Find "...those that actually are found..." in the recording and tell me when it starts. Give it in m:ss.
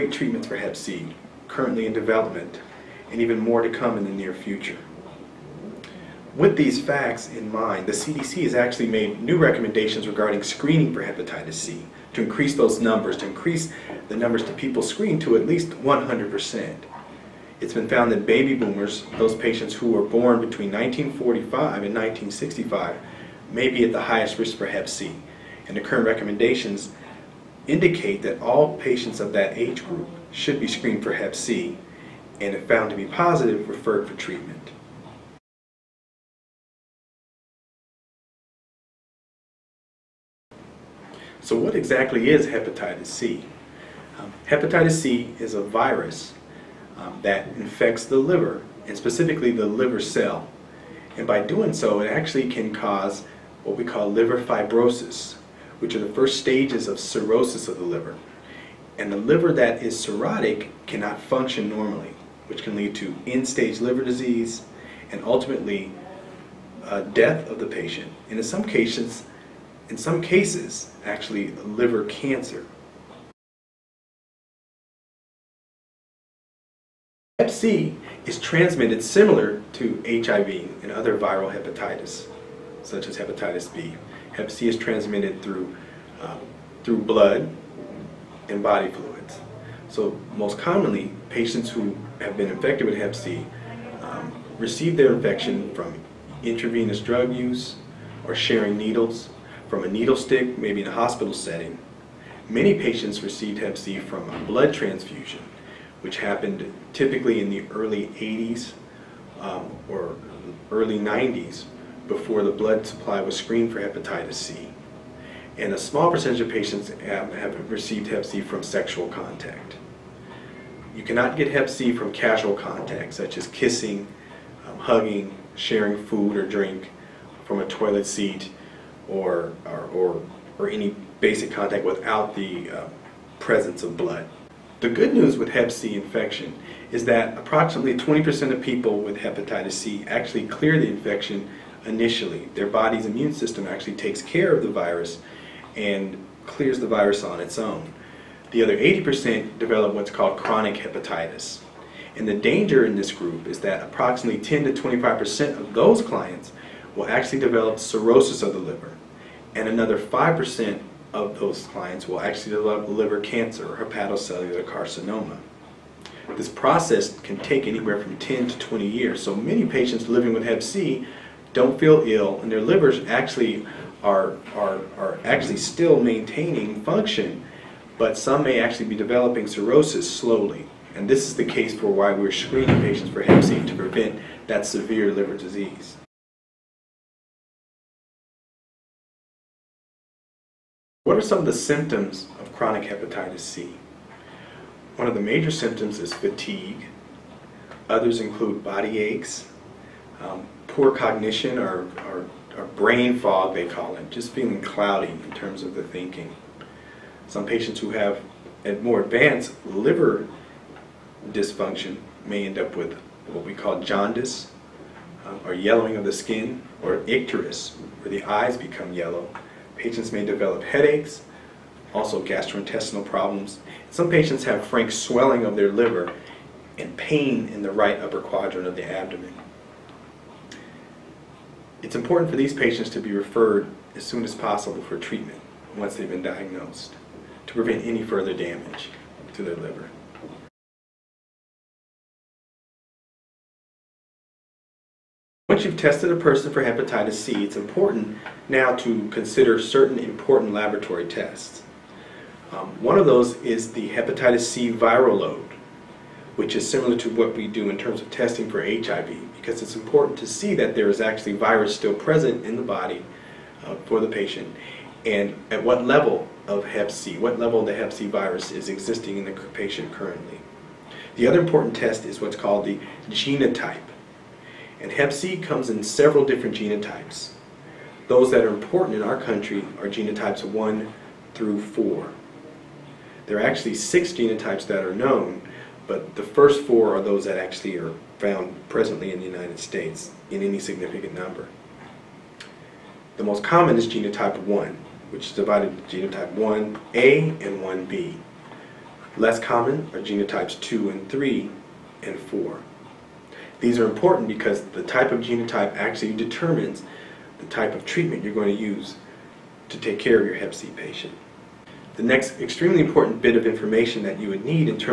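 4:47.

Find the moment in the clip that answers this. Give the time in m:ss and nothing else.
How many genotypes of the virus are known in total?
4:43.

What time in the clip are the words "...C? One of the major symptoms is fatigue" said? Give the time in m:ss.
3:13.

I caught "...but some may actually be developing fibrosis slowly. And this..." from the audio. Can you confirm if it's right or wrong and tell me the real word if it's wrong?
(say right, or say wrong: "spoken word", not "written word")
wrong: "cirrhosis", not "fibrosis".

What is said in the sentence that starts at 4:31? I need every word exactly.
The other important test is what's called the genotype.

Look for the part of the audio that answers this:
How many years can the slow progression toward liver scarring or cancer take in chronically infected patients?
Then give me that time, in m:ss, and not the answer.
2:48.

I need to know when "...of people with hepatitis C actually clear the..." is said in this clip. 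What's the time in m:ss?
2:18.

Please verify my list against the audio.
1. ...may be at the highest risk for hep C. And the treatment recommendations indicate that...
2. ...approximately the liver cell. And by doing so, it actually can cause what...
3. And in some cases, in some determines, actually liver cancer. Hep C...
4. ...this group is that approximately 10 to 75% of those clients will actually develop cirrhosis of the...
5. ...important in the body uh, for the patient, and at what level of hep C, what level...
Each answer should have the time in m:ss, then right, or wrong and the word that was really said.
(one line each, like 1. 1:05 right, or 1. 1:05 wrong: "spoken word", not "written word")
1. 0:23 wrong: "current", not "treatment"
2. 0:48 wrong: "specifically", not "approximately"
3. 1:08 wrong: "cases", not "determines"
4. 2:32 wrong: "25", not "75"
5. 4:21 wrong: "present", not "important".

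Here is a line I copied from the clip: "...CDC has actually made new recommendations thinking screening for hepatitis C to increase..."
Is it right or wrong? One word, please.
wrong.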